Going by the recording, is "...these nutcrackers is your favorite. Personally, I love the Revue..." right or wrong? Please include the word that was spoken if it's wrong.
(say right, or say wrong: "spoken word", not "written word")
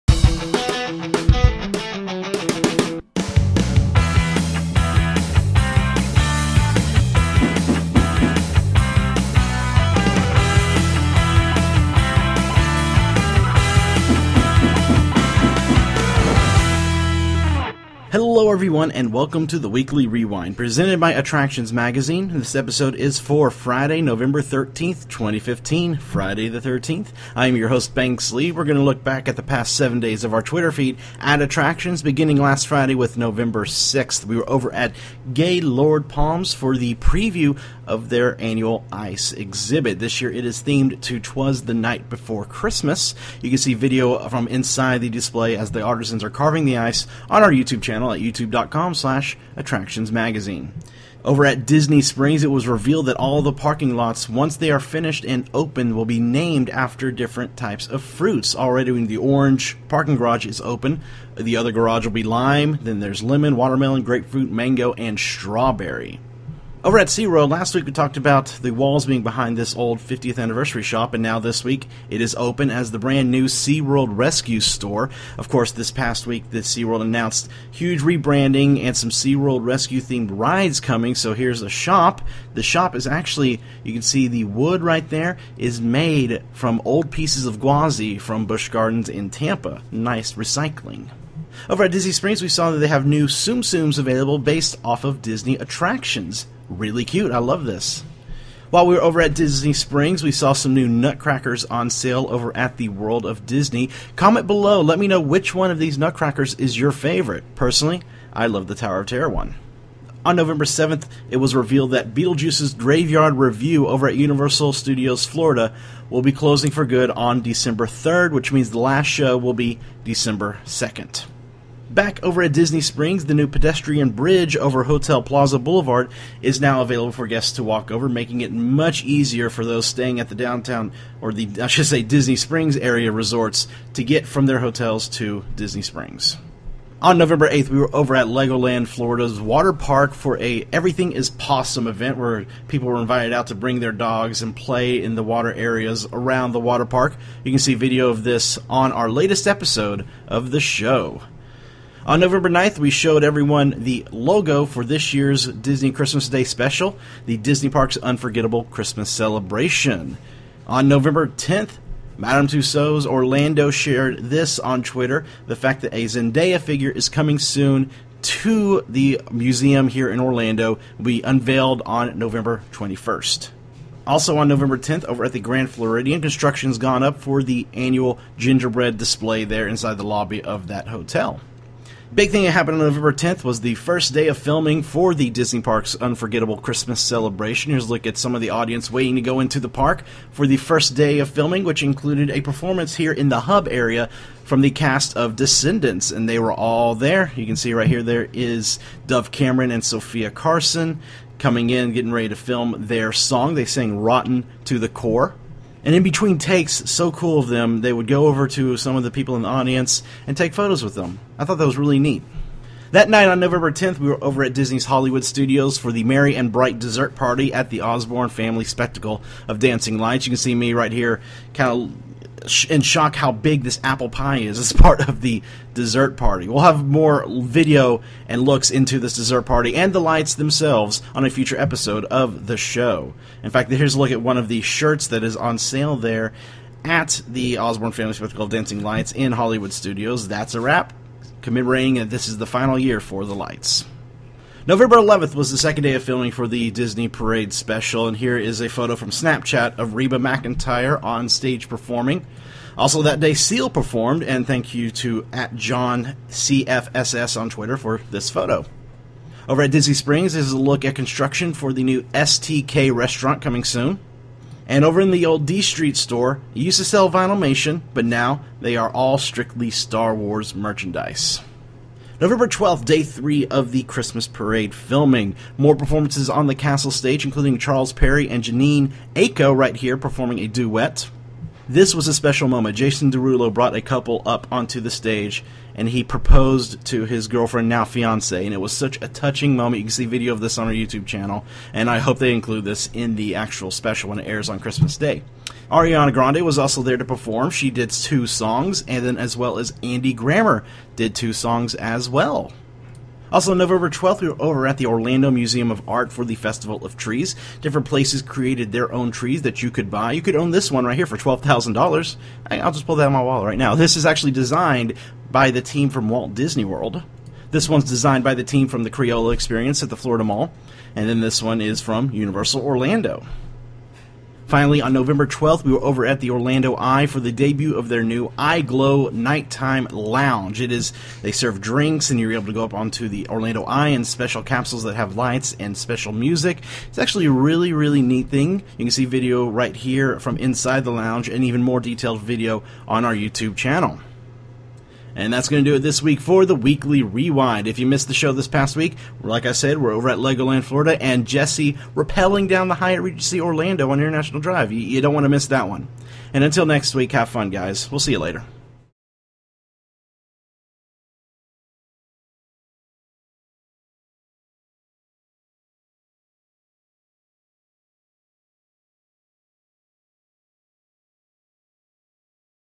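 wrong: "Tower", not "Revue".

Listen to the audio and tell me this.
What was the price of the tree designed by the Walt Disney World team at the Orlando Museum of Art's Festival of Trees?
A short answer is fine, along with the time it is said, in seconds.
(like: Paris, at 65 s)
$12,000, at 311 s.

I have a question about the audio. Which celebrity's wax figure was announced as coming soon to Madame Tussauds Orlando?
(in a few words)
Zendaya.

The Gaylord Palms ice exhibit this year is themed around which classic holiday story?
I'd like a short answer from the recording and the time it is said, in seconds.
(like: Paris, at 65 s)
Twas the Night Before Christmas, at 41 s.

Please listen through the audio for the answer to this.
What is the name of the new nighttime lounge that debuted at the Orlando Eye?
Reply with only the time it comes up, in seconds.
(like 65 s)
328 s.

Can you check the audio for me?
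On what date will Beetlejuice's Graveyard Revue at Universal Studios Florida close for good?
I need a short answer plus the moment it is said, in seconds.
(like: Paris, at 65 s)
December 3rd, at 117 s.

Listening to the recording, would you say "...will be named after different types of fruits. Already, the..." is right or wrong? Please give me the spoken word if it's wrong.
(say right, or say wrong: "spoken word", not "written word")
right.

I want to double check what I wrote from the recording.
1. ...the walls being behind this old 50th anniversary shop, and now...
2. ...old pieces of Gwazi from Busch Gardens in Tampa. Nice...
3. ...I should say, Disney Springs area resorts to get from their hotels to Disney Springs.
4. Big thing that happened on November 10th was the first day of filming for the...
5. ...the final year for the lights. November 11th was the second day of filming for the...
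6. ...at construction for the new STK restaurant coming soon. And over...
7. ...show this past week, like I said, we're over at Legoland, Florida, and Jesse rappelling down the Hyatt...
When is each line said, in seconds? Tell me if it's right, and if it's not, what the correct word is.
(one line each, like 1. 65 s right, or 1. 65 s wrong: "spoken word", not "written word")
1. 68 s right
2. 86 s right
3. 131 s right
4. 182 s right
5. 242 s right
6. 260 s right
7. 348 s right.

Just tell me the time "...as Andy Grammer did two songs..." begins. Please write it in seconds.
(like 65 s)
299 s.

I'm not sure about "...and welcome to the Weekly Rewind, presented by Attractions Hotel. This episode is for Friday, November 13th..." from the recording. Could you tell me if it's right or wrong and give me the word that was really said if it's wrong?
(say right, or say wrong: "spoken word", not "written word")
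wrong: "Magazine", not "Hotel".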